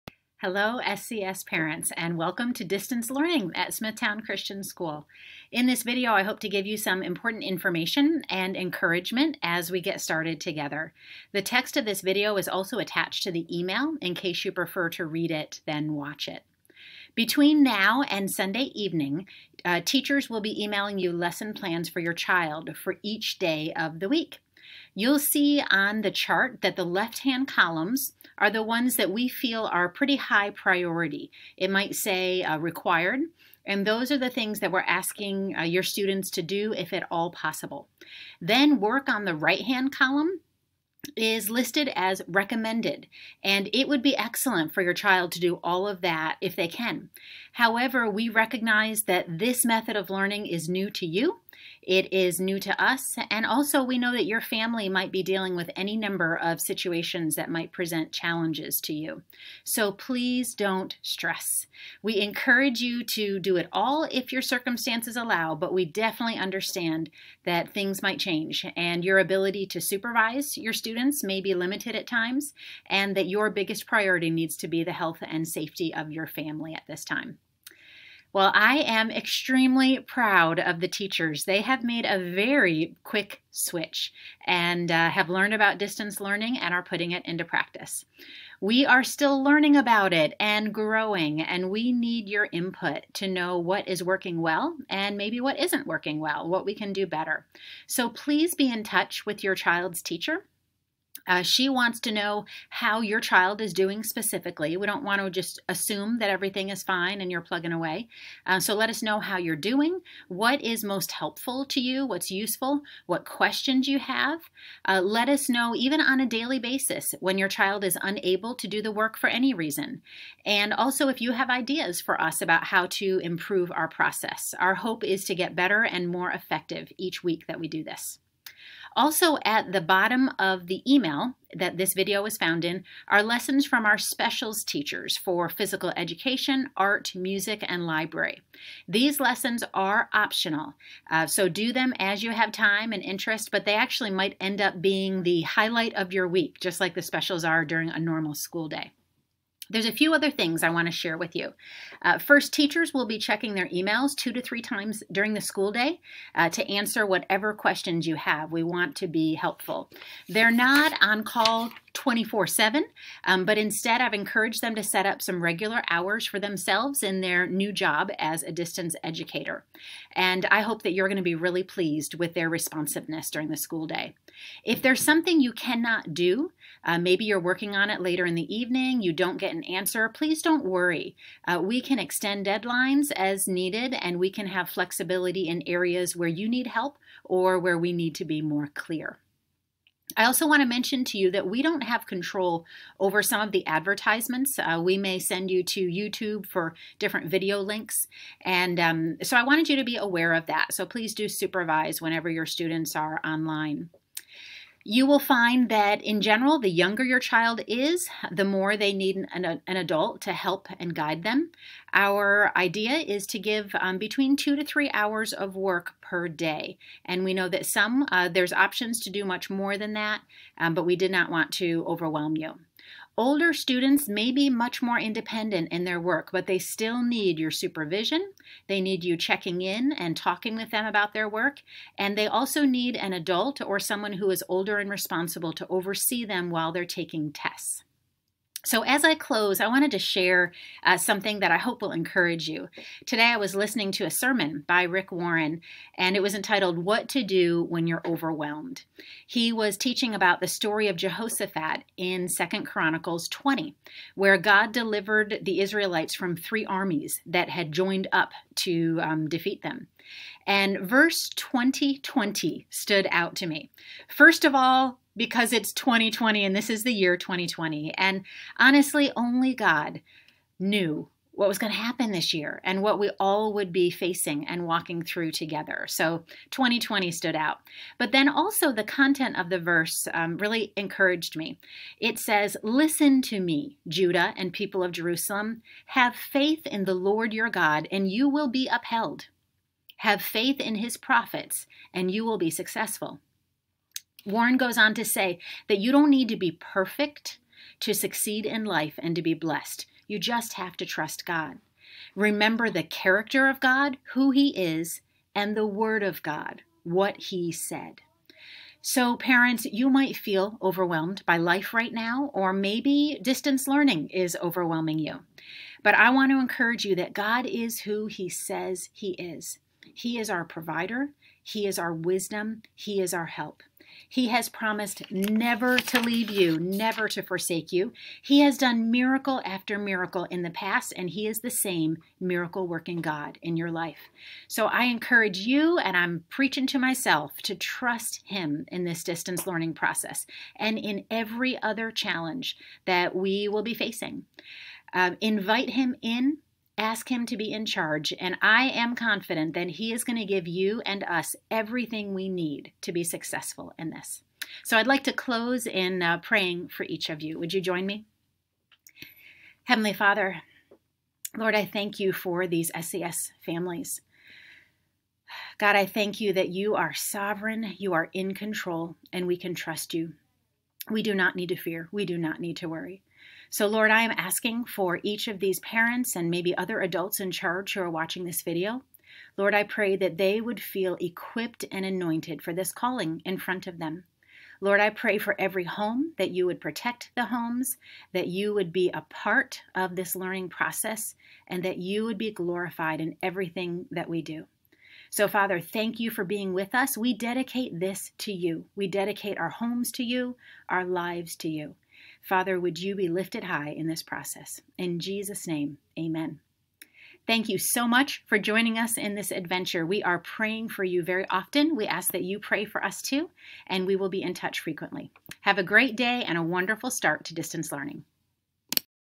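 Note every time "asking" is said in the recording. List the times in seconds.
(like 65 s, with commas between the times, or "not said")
34 s, 374 s.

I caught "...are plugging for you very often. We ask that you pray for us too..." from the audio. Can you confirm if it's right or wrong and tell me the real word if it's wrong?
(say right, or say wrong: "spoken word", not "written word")
wrong: "praying", not "plugging".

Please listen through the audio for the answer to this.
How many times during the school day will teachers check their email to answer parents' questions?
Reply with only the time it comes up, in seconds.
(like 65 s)
154 s.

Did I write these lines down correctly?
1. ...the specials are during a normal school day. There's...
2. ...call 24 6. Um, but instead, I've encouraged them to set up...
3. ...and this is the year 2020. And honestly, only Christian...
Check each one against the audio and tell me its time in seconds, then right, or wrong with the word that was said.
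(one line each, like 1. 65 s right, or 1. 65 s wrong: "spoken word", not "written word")
1. 146 s right
2. 161 s wrong: "7", not "6"
3. 266 s wrong: "God", not "Christian".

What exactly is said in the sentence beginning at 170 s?
And I hope that you're going to be really pleased with their responsiveness during the school day.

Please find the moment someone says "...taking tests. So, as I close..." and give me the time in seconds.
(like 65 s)
236 s.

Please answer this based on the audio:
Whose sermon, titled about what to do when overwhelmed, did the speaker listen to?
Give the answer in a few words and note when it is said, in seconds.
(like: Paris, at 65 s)
Rick Warren, at 244 s.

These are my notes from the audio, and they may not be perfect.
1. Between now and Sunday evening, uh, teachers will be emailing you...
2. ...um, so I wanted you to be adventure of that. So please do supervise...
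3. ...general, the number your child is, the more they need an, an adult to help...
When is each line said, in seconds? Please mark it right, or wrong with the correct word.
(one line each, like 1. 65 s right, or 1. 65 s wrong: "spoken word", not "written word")
1. 17 s right
2. 198 s wrong: "aware", not "adventure"
3. 206 s wrong: "younger", not "number".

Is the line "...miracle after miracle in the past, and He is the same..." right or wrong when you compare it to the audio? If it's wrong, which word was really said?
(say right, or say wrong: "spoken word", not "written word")
right.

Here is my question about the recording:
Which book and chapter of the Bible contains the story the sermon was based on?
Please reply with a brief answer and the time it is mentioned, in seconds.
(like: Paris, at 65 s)
Second Chronicles 20, at 252 s.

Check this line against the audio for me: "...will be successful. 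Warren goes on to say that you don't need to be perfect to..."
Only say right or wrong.
right.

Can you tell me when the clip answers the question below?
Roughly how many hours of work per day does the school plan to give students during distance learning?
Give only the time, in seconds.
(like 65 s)
214 s.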